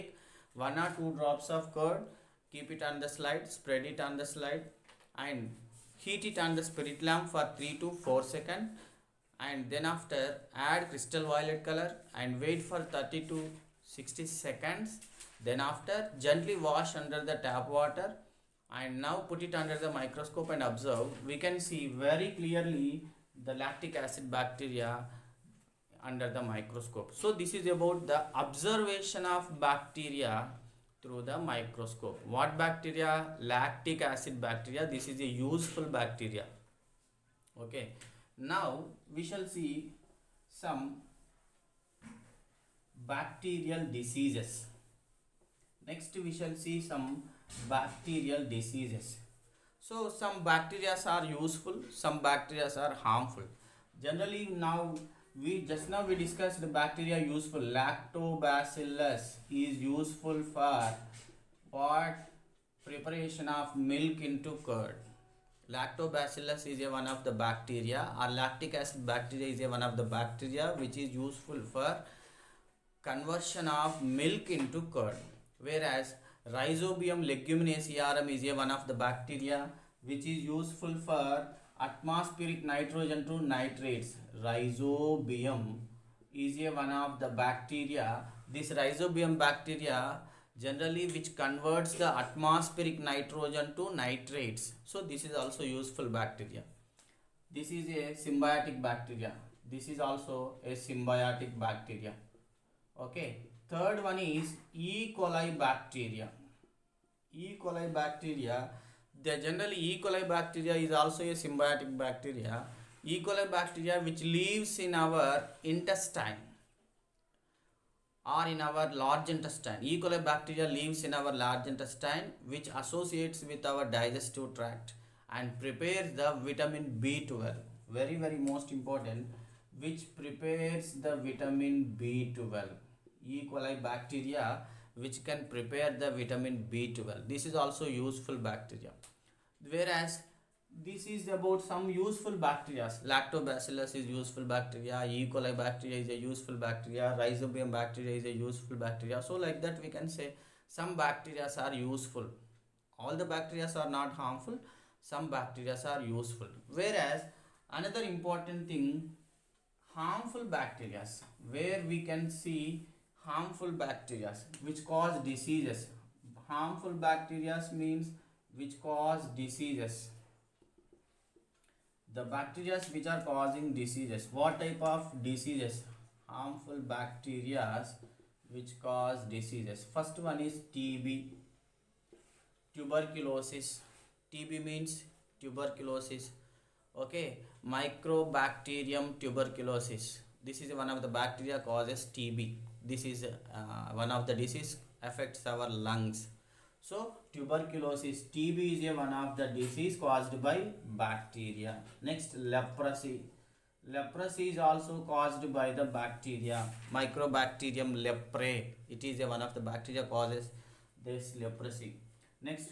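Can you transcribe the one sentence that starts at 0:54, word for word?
Generally now we just now we discussed the bacteria useful.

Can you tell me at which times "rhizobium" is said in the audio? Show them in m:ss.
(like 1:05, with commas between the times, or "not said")
1:16, 1:24, 1:28, 2:27.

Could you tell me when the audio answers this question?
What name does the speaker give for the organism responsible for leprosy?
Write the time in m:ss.
3:26.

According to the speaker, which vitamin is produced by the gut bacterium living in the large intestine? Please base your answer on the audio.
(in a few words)
vitamin B12.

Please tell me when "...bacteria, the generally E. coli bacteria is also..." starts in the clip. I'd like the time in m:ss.
1:47.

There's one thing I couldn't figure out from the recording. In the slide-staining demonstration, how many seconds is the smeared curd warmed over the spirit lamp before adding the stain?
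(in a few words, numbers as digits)
3 to 4 seconds.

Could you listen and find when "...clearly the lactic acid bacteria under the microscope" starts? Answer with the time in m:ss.
0:22.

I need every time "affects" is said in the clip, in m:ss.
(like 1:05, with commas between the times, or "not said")
3:15.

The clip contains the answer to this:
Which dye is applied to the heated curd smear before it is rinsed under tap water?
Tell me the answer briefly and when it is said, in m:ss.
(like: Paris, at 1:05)
crystal violet, at 0:10.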